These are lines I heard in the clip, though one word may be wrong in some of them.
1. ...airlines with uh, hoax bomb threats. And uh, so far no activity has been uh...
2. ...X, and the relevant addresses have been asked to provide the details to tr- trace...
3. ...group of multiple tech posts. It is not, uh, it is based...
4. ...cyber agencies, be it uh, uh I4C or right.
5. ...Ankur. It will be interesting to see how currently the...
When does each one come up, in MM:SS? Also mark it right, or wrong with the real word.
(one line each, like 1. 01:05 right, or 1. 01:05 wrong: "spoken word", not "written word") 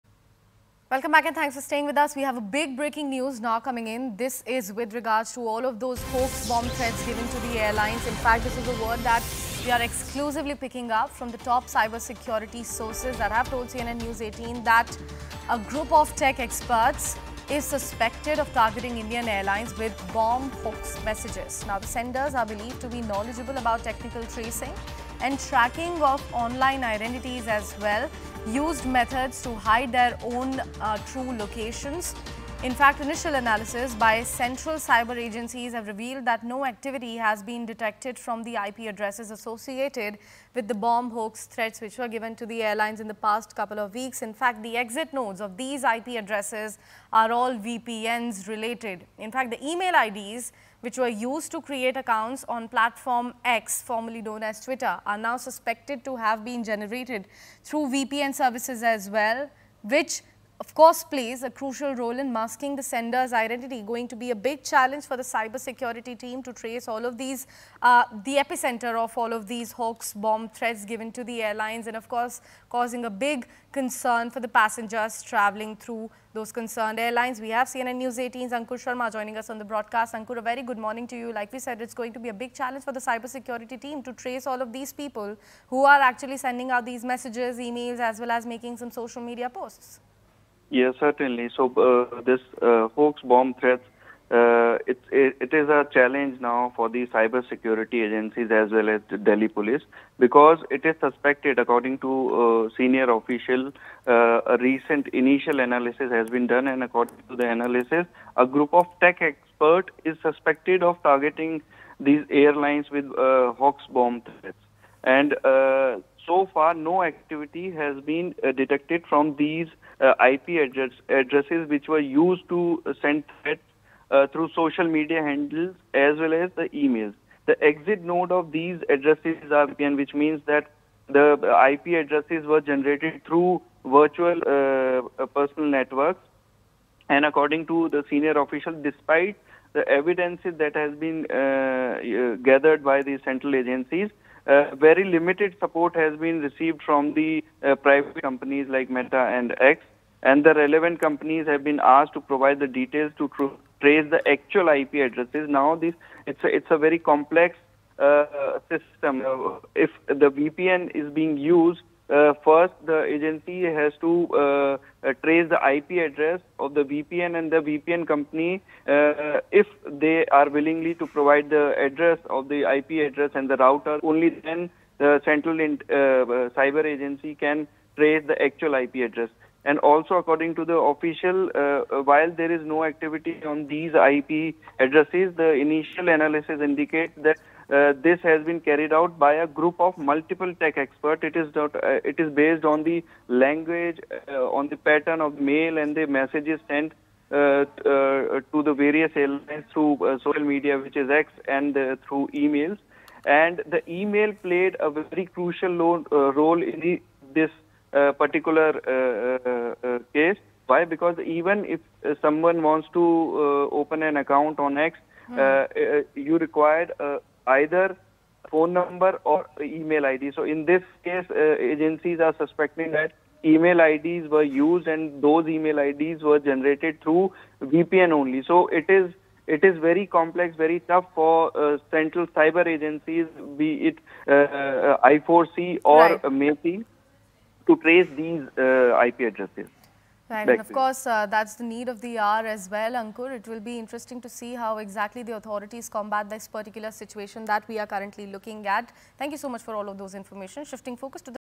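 1. 01:52 right
2. 02:29 wrong: "companies", not "addresses"
3. 03:09 wrong: "experts", not "posts"
4. 03:52 right
5. 04:02 wrong: "exactly", not "currently".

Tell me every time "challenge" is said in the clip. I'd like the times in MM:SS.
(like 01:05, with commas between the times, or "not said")
01:04, 01:22, 01:35.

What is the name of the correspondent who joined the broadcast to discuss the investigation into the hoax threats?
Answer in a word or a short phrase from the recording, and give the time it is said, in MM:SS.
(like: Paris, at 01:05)
Ankur Sharma, at 01:18.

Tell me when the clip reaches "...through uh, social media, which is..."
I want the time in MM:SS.
03:19.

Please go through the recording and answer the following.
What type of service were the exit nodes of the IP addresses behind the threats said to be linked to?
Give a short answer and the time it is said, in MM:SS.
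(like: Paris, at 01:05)
VPNs, at 00:47.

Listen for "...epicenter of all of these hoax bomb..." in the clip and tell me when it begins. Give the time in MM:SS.
01:08.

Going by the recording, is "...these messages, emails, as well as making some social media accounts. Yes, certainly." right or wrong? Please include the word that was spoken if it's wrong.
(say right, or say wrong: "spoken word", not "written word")
wrong: "posts", not "accounts".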